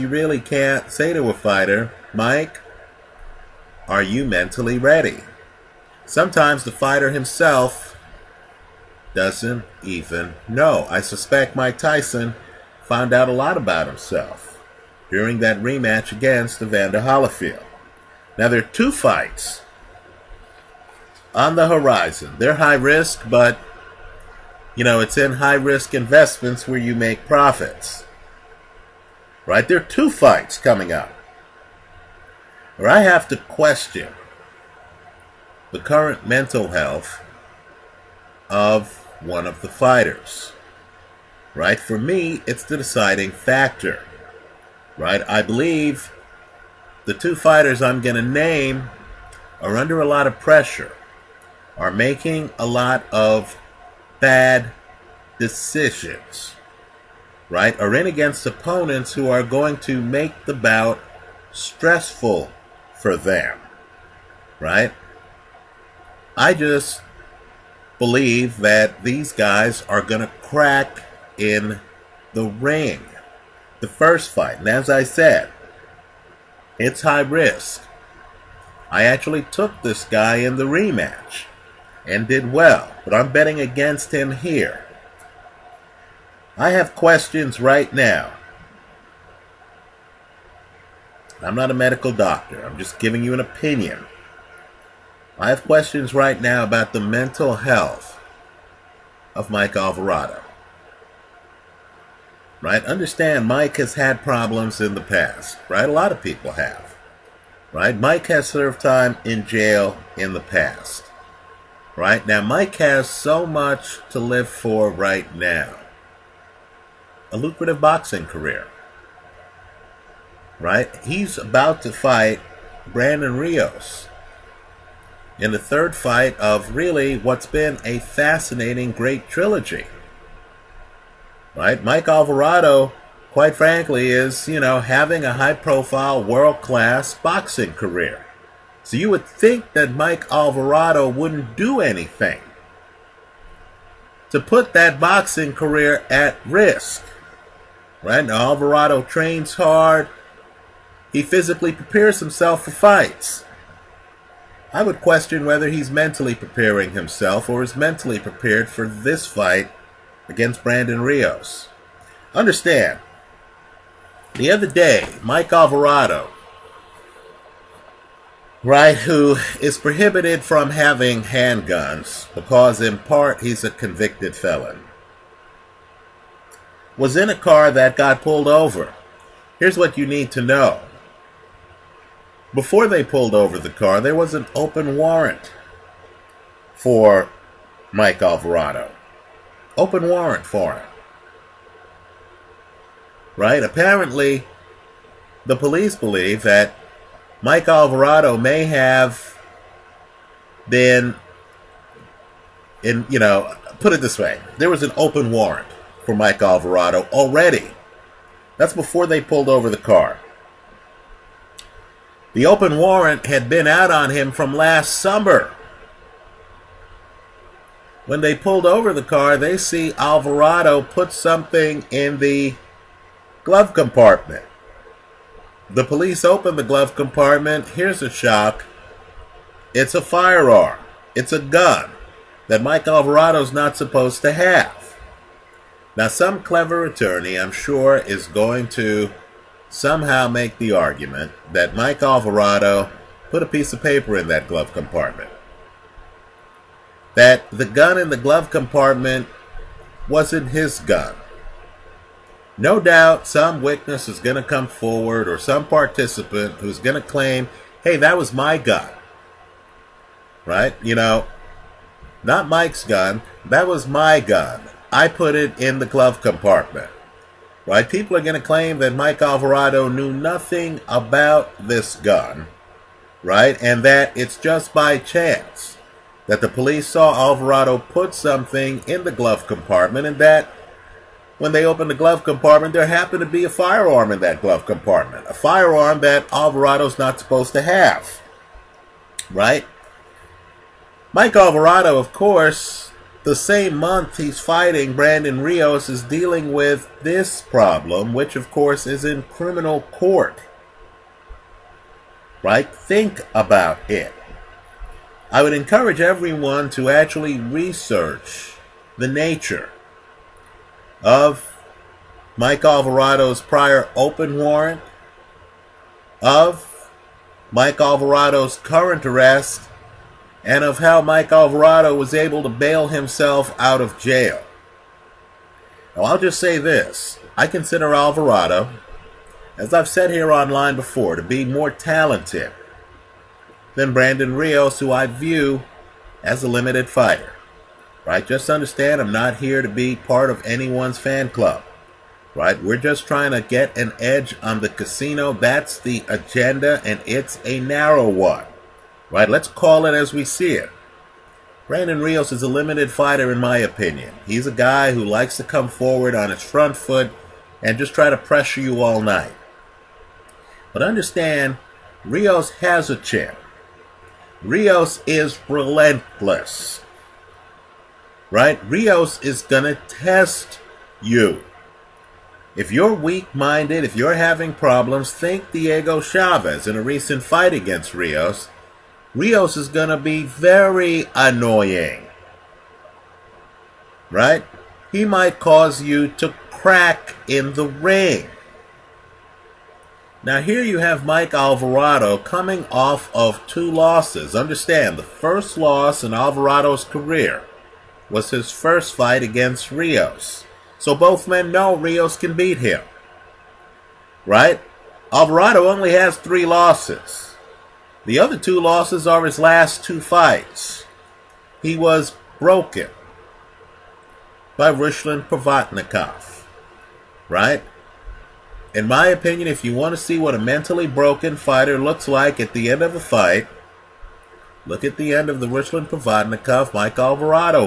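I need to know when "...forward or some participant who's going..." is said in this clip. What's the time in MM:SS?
04:14.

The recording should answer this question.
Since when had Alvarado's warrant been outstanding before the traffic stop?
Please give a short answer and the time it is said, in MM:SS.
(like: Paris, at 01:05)
last summer, at 03:34.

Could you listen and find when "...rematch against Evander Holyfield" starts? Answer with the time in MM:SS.
00:15.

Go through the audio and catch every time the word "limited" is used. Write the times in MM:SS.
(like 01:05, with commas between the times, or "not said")
05:36, 05:52.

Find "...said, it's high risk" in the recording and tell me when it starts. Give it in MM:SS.
01:15.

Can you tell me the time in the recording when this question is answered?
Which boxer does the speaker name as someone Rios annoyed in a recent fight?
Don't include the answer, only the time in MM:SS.
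06:15.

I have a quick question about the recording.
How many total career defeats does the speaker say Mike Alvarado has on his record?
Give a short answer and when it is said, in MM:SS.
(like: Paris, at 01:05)
3, at 06:46.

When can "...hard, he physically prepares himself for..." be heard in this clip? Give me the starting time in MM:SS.
02:29.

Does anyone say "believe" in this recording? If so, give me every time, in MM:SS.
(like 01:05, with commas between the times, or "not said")
00:45, 01:07, 03:15.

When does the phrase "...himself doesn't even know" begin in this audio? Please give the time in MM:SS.
00:07.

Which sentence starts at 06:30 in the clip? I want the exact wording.
Now here you have Mike Alvarado coming off of two losses.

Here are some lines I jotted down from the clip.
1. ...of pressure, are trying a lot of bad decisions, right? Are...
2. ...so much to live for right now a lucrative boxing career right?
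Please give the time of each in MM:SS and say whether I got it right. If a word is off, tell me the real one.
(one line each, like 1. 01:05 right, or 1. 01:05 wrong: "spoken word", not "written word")
1. 00:50 wrong: "making", not "trying"
2. 01:53 right.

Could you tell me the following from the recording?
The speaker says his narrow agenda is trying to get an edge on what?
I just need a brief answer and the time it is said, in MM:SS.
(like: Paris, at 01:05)
the casino, at 05:44.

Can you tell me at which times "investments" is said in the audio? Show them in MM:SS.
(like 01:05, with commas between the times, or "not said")
00:25.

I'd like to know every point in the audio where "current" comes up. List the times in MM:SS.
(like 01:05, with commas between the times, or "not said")
00:35, 05:18.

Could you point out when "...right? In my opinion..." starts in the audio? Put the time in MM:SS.
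06:57.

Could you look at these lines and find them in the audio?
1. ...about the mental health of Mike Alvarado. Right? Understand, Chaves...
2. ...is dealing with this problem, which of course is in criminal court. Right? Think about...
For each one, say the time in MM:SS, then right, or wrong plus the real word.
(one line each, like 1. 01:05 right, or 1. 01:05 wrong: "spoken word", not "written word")
1. 01:36 wrong: "Mike", not "Chaves"
2. 04:55 right.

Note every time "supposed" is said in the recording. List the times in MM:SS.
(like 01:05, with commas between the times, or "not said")
03:53, 04:47.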